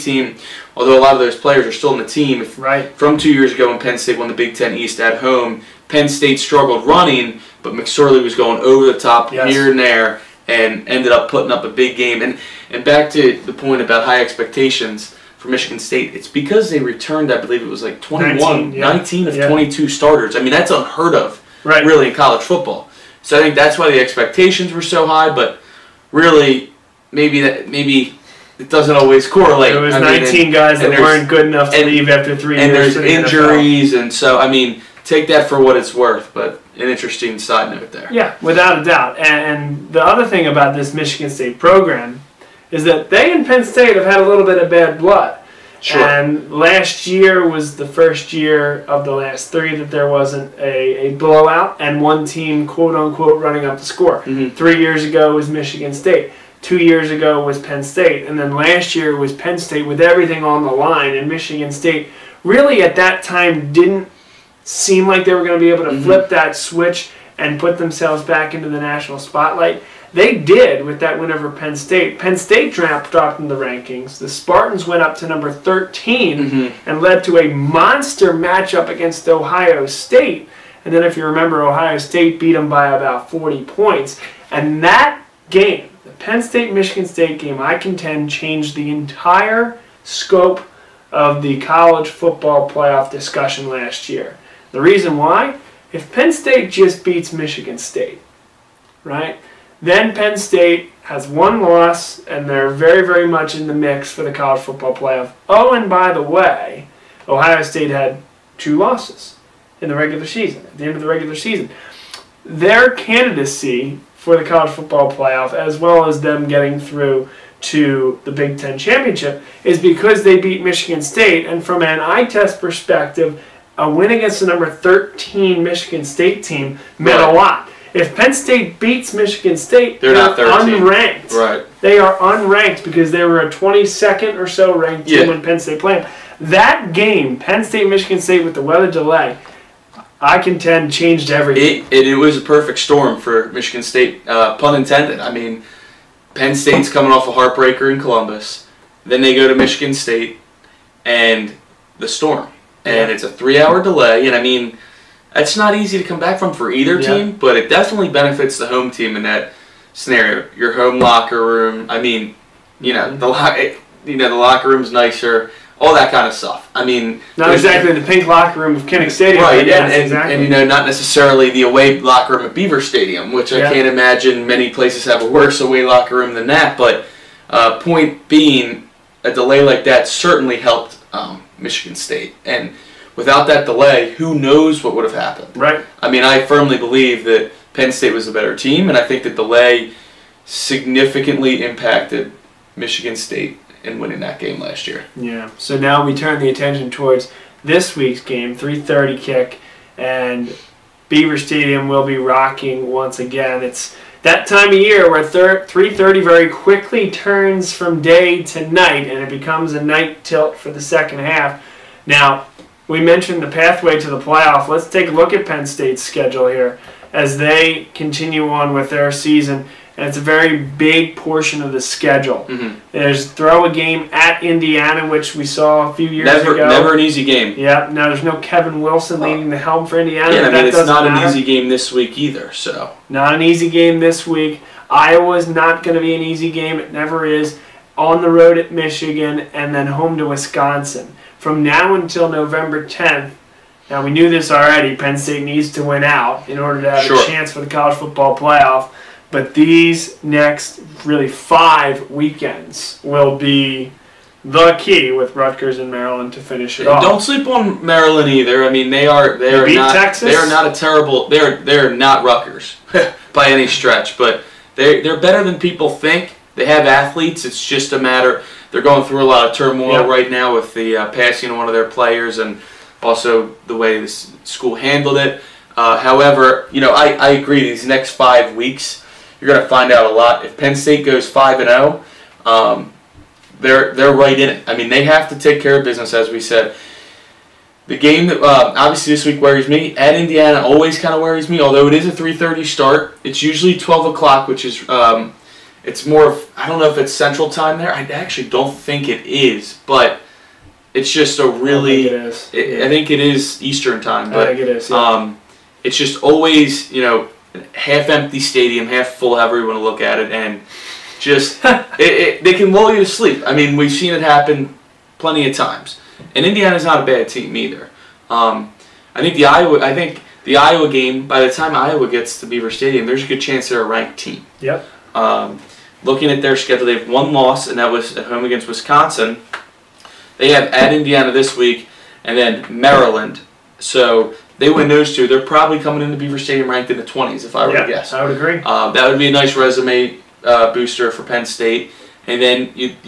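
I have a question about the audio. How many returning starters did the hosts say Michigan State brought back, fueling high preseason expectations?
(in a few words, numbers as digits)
19.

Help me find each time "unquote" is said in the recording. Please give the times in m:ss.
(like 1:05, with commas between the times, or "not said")
0:52.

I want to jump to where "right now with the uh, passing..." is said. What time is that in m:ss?
4:30.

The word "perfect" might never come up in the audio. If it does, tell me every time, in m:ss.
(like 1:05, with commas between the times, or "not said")
2:22.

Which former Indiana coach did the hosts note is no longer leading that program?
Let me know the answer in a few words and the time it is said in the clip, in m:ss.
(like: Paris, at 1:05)
Kevin Wilson, at 3:48.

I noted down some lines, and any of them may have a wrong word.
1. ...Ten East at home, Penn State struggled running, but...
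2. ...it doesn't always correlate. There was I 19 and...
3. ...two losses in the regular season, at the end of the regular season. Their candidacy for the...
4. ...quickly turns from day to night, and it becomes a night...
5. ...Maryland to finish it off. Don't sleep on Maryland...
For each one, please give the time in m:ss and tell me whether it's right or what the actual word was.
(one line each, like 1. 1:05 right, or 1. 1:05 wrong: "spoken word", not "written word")
1. 0:04 right
2. 0:28 right
3. 1:48 right
4. 3:26 right
5. 4:15 right.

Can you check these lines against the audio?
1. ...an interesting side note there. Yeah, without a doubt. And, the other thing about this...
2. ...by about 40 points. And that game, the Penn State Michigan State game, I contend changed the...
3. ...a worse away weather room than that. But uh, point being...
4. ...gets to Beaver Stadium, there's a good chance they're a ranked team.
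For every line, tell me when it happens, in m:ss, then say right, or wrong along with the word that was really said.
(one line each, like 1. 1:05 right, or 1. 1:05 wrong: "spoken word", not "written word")
1. 0:36 right
2. 1:22 right
3. 2:55 wrong: "locker", not "weather"
4. 5:22 right.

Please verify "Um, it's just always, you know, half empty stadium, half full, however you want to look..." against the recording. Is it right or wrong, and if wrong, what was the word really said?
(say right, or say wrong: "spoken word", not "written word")
right.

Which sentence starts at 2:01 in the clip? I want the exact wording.
And from an eye test perspective, a win against the number 13 Michigan State team meant a lot.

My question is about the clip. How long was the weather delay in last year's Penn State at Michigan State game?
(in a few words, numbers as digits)
three hour.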